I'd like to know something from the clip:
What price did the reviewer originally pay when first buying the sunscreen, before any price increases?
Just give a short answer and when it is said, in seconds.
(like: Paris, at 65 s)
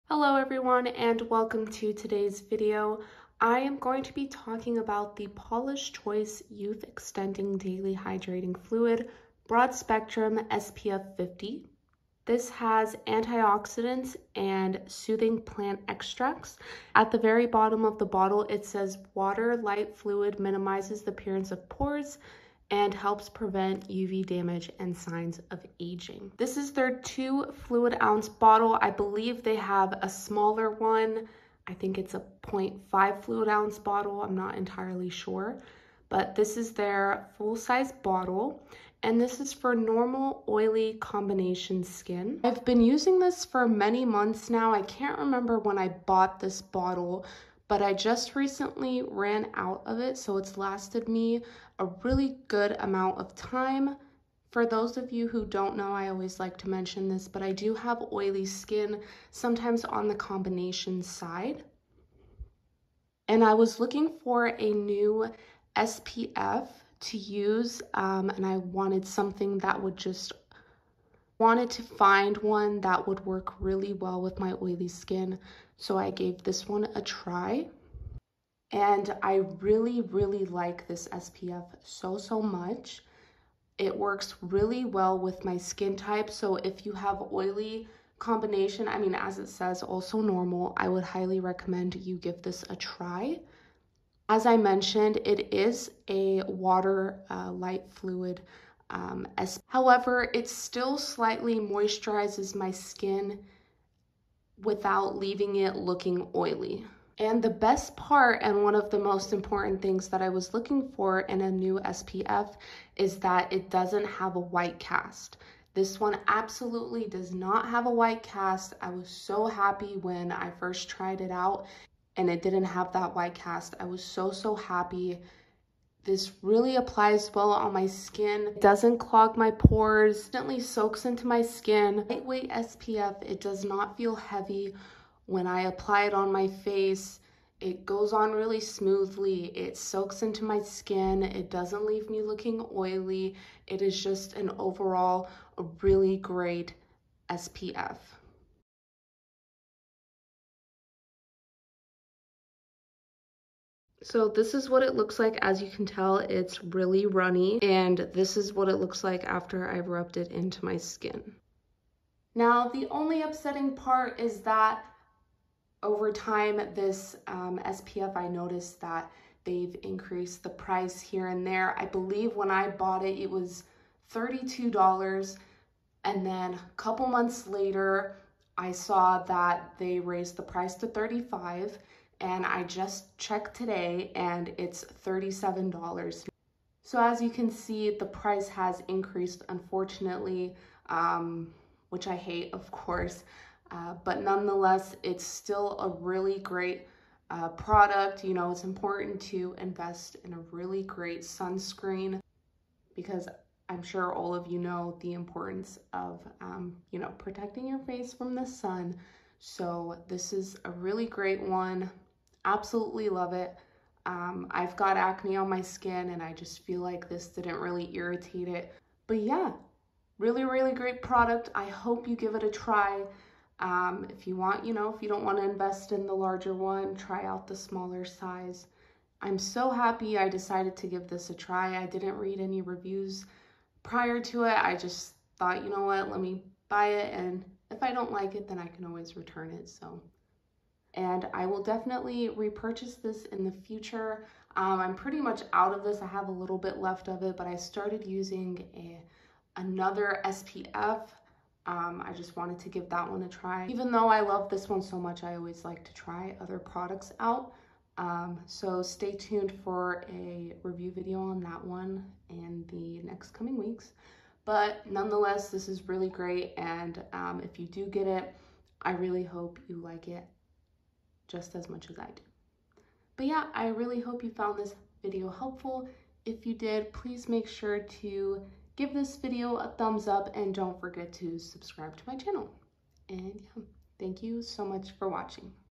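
$32, at 174 s.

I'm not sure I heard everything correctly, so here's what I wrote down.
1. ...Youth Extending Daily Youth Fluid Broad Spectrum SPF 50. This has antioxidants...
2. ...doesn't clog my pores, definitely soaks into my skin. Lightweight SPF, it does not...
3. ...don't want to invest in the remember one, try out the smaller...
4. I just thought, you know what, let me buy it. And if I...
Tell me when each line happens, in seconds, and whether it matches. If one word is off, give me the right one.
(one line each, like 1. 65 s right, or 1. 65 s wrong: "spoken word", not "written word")
1. 6 s wrong: "Hydrating", not "Youth"
2. 128 s wrong: "gently", not "definitely"
3. 225 s wrong: "larger", not "remember"
4. 234 s right.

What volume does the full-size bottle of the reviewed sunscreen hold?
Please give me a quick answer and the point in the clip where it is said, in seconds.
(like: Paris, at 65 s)
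2 fluid ounces, at 27 s.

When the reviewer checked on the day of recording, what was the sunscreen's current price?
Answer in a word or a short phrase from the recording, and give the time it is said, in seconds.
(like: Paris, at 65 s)
$37, at 185 s.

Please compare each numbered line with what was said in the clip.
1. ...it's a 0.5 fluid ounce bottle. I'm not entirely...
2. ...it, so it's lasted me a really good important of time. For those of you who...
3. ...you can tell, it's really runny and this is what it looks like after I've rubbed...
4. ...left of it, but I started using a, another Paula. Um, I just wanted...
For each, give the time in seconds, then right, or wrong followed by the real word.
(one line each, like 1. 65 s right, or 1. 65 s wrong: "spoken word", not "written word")
1. 31 s right
2. 49 s wrong: "amount", not "important"
3. 155 s right
4. 246 s wrong: "SPF", not "Paula".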